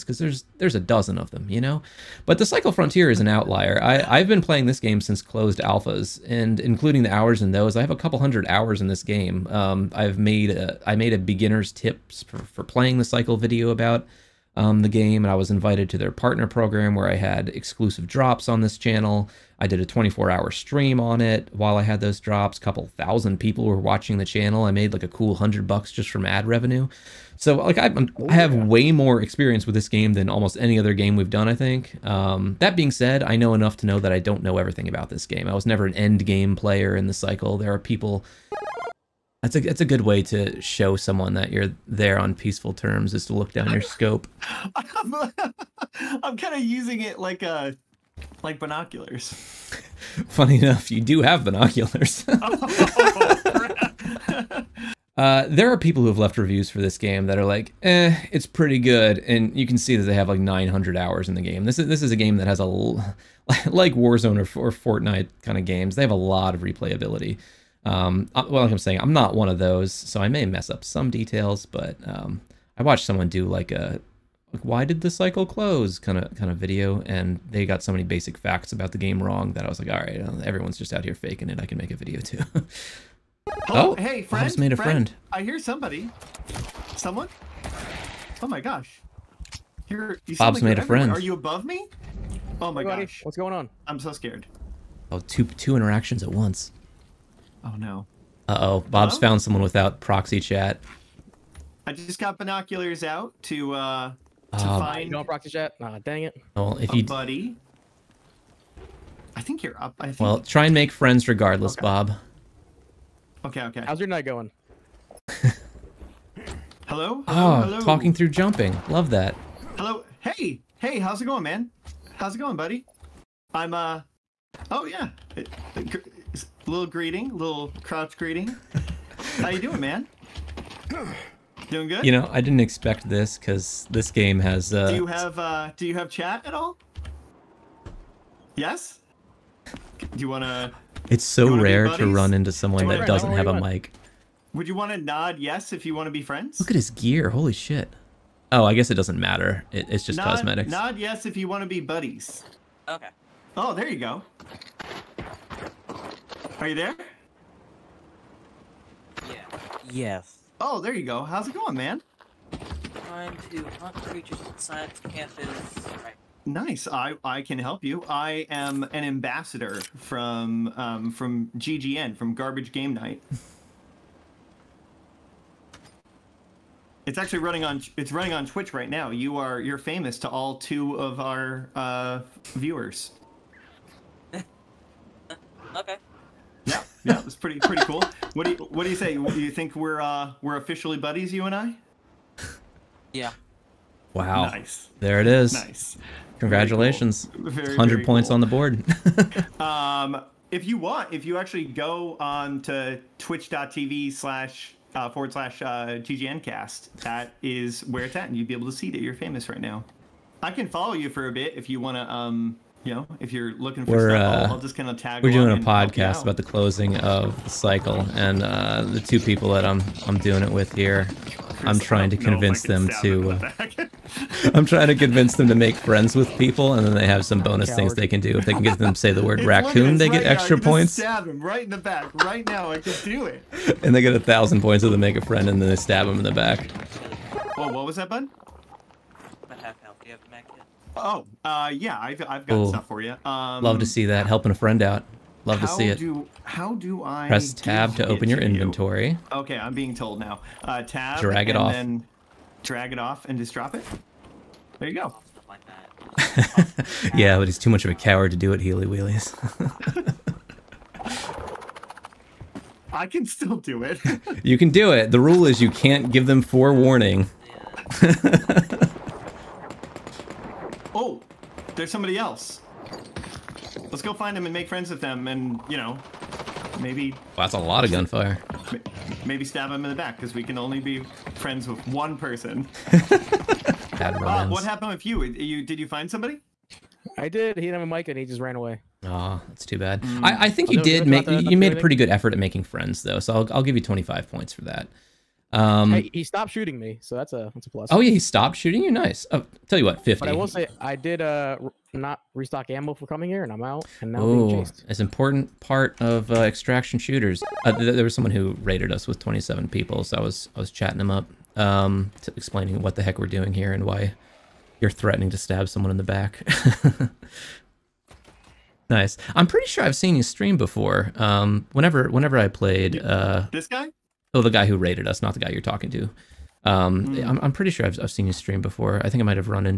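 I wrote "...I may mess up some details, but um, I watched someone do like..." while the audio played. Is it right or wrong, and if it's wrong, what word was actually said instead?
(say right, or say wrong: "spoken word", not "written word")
right.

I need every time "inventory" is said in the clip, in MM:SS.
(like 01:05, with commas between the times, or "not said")
04:08.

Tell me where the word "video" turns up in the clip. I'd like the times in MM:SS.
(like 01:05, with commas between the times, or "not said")
00:13, 01:16, 01:21.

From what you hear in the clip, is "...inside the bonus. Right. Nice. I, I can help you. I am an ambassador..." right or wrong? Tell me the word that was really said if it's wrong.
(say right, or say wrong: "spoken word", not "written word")
wrong: "campus", not "bonus".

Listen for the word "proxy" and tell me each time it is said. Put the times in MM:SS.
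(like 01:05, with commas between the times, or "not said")
01:39, 01:45.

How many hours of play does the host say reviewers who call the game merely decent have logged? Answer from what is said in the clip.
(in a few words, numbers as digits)
900.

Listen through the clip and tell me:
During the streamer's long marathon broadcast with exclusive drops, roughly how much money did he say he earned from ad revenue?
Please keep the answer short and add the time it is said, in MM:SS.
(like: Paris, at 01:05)
100 bucks, at 00:25.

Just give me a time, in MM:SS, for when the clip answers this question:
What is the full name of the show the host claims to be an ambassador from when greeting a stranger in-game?
02:52.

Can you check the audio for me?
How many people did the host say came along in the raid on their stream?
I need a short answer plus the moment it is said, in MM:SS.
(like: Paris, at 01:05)
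27, at 05:09.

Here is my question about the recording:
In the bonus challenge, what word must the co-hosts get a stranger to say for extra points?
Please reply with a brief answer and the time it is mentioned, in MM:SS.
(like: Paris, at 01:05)
raccoon, at 03:49.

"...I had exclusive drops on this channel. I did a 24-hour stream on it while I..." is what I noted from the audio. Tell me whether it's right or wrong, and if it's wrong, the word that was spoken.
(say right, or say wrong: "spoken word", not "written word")
right.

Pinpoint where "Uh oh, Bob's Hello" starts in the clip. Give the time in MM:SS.
01:38.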